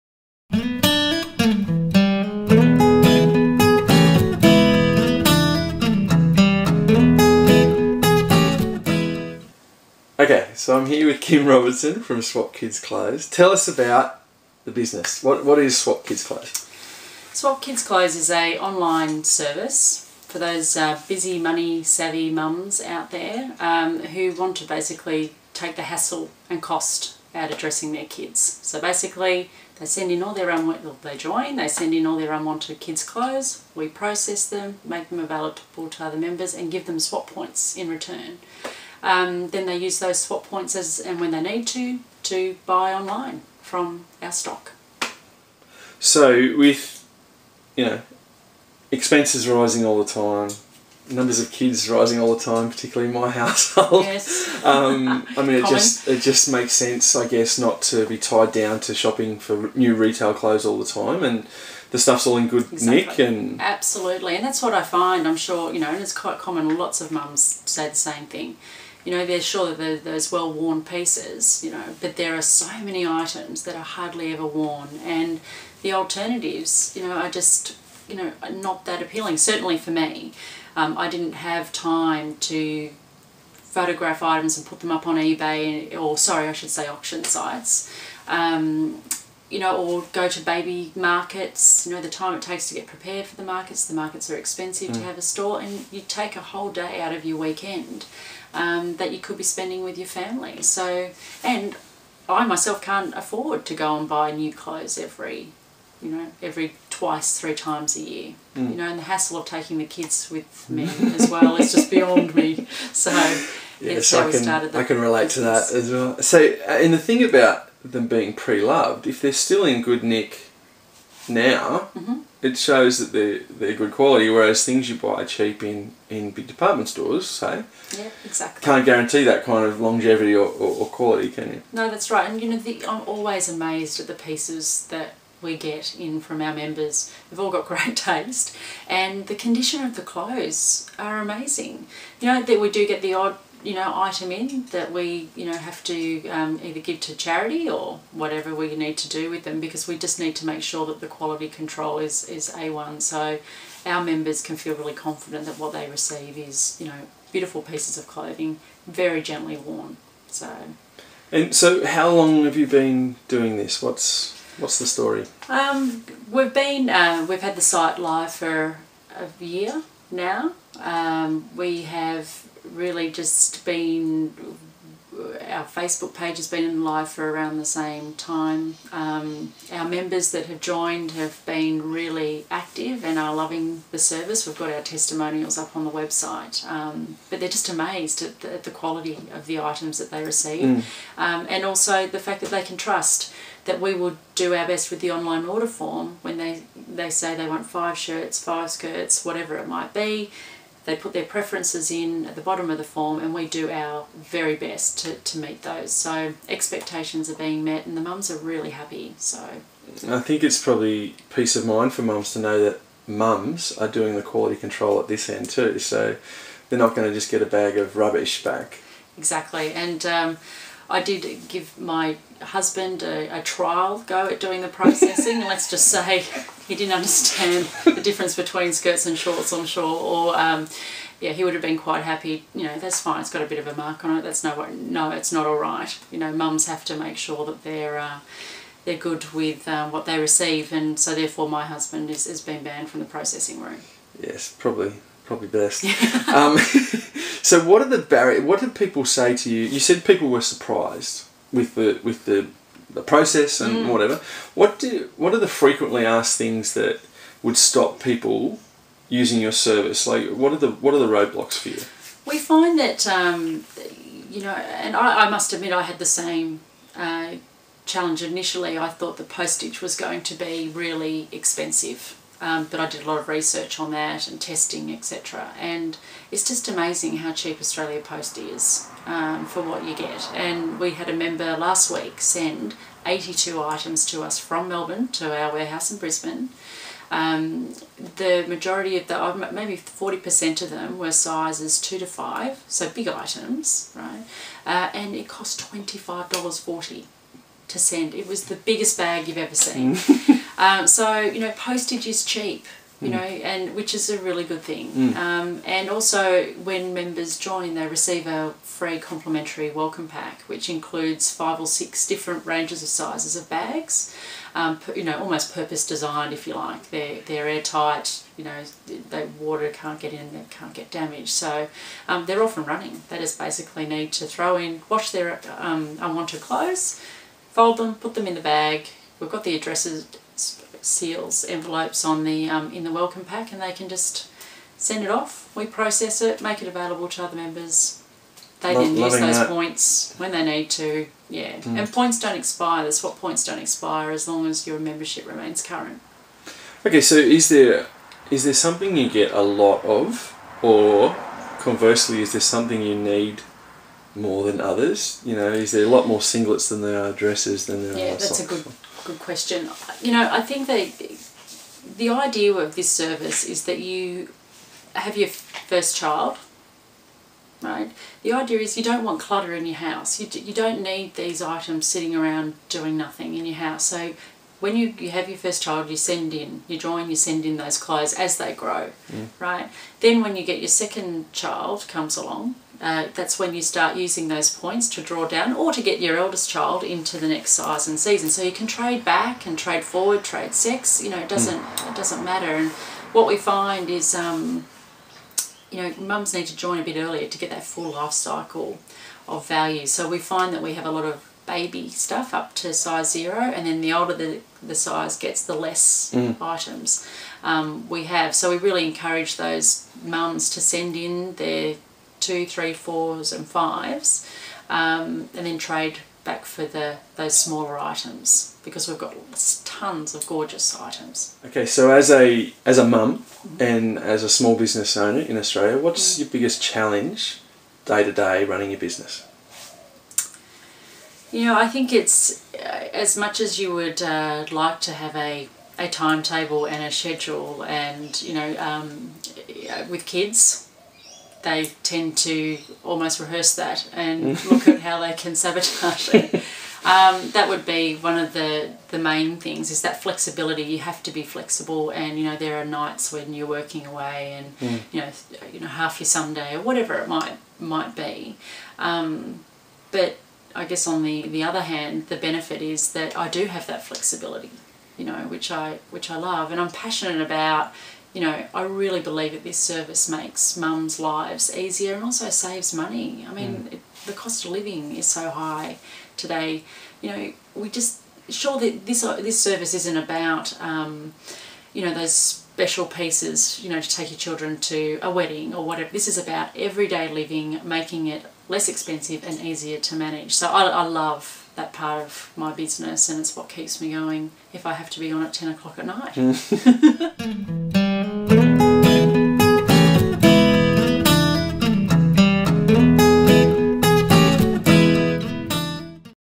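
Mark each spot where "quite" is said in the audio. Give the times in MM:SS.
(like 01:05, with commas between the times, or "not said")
01:06, 03:51.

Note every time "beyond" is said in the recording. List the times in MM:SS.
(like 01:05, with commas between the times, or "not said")
01:51.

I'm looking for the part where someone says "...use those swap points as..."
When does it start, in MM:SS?
00:39.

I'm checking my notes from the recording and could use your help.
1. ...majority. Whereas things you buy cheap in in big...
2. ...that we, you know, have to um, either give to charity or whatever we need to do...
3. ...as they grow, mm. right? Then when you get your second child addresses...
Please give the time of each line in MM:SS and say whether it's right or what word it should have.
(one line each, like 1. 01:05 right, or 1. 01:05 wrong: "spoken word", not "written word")
1. 02:03 wrong: "quality", not "majority"
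2. 02:24 right
3. 06:18 wrong: "comes", not "addresses".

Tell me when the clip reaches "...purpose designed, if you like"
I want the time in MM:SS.
05:15.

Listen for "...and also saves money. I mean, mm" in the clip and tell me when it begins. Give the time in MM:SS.
07:51.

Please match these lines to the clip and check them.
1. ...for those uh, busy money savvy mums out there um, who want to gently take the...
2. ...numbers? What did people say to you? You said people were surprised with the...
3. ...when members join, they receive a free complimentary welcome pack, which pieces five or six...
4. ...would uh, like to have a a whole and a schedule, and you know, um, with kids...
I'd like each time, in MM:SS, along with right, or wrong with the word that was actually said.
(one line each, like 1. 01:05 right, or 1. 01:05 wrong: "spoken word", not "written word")
1. 00:20 wrong: "basically", not "gently"
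2. 04:07 wrong: "barriers", not "numbers"
3. 05:06 wrong: "includes", not "pieces"
4. 07:13 wrong: "timetable", not "whole".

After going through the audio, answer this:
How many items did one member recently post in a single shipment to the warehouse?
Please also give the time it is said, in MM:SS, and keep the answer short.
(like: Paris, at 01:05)
82, at 04:43.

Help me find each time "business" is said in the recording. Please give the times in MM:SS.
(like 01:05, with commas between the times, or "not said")
00:14, 01:55, 07:04, 07:08, 08:12.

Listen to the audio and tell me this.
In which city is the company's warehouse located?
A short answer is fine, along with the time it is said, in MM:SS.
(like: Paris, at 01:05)
Brisbane, at 04:45.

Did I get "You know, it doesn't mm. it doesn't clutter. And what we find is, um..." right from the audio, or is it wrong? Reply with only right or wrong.
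wrong.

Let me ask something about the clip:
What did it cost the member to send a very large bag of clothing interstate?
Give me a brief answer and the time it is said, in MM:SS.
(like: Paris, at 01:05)
$25.40, at 04:55.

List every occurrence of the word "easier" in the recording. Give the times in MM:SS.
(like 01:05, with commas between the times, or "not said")
07:51, 08:09.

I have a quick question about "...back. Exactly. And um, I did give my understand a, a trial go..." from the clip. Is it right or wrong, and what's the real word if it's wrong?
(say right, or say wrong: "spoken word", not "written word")
wrong: "husband", not "understand".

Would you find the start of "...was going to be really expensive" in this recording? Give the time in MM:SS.
04:29.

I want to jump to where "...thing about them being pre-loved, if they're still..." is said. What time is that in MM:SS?
01:56.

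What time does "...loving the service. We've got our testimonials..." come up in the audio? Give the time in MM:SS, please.
03:03.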